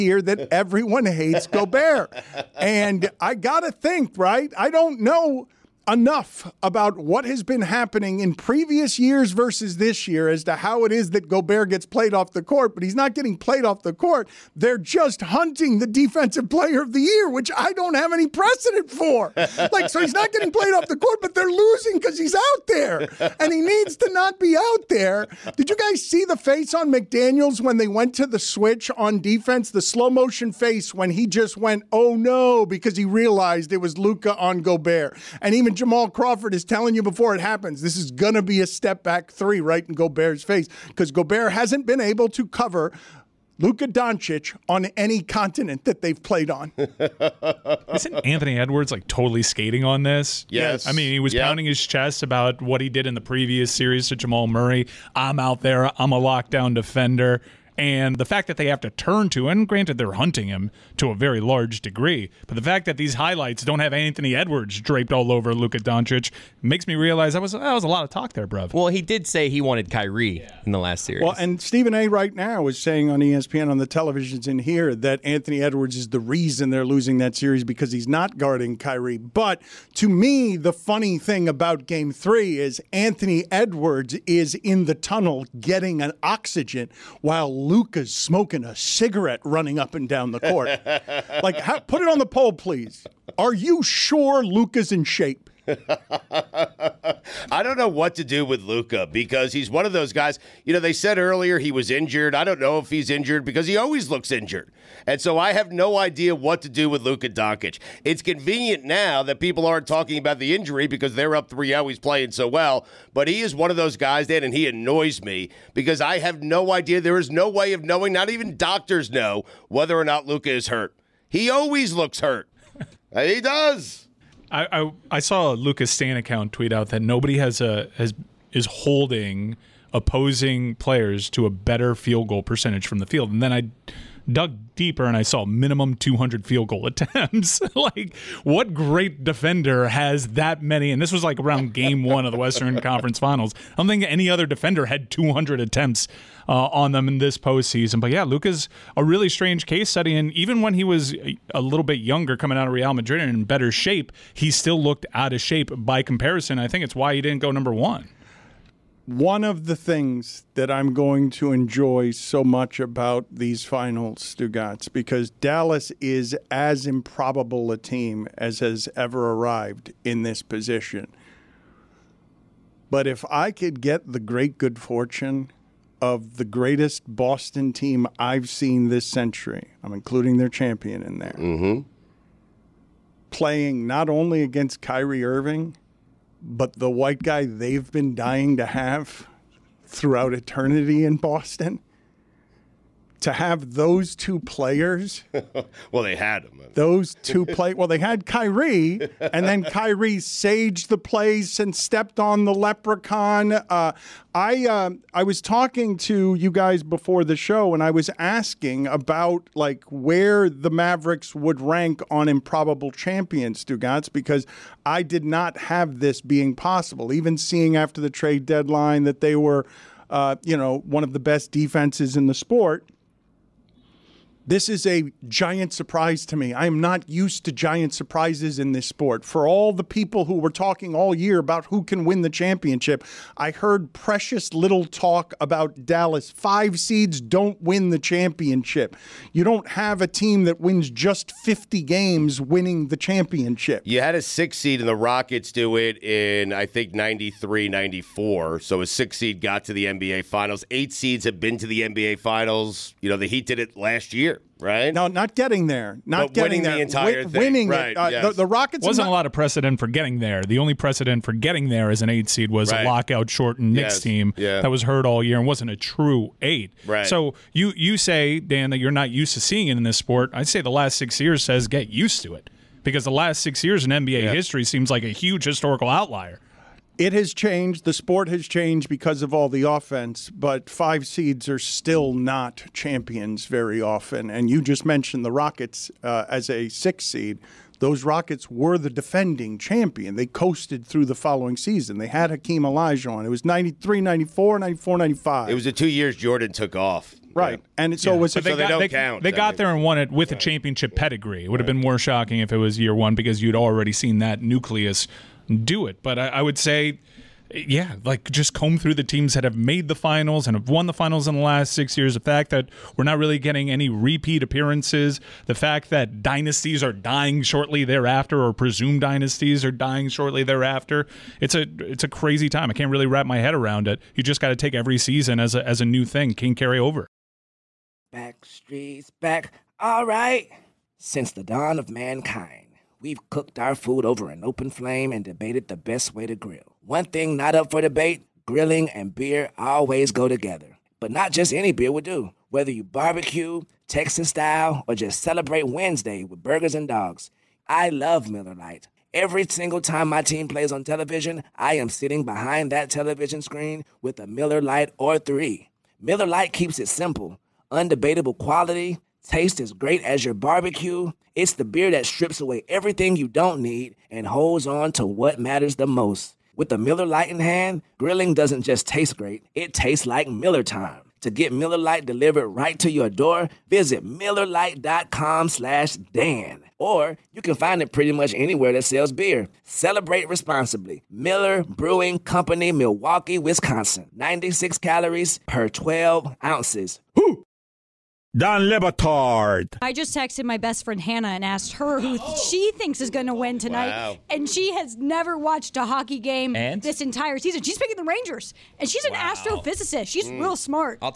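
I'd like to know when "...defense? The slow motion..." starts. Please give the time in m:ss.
0:29.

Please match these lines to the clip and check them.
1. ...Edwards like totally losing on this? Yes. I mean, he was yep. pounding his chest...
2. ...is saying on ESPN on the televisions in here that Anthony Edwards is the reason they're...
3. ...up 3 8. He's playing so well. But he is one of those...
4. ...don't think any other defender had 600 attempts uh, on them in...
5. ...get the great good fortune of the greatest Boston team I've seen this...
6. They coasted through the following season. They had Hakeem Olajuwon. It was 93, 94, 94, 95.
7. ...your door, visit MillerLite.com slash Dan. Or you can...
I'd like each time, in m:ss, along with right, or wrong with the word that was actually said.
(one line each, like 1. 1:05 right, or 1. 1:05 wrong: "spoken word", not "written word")
1. 0:48 wrong: "skating", not "losing"
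2. 1:12 right
3. 1:51 wrong: "0", not "8"
4. 2:23 wrong: "200", not "600"
5. 2:53 right
6. 4:50 right
7. 6:12 right.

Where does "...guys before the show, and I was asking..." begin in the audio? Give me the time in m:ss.
3:26.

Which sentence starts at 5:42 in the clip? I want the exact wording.
Whether you barbecue, Texas style, or just celebrate Wednesday with burgers and dogs, I love Miller Lite.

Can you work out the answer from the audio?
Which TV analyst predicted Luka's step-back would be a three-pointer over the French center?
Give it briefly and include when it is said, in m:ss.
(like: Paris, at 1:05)
Jamal Crawford, at 0:35.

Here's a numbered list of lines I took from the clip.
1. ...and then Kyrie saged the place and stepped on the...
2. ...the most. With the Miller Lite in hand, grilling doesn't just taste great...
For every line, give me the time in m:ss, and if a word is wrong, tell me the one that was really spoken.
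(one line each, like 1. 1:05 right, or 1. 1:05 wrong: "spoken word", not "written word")
1. 3:19 right
2. 6:05 right.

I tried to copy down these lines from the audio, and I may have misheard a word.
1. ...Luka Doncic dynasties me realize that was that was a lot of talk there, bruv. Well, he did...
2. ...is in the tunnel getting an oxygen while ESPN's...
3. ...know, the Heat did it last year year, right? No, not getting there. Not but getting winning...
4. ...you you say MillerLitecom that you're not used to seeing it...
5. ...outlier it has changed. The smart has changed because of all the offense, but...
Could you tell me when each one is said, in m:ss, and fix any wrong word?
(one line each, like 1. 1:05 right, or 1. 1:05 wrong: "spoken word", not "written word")
1. 1:05 wrong: "makes", not "dynasties"
2. 1:24 wrong: "Luka", not "ESPN"
3. 4:13 right
4. 4:27 wrong: "Dan", not "MillerLitecom"
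5. 4:35 wrong: "sport", not "smart".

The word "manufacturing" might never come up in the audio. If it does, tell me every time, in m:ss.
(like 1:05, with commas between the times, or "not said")
not said.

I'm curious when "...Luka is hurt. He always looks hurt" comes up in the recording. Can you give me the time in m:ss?
2:00.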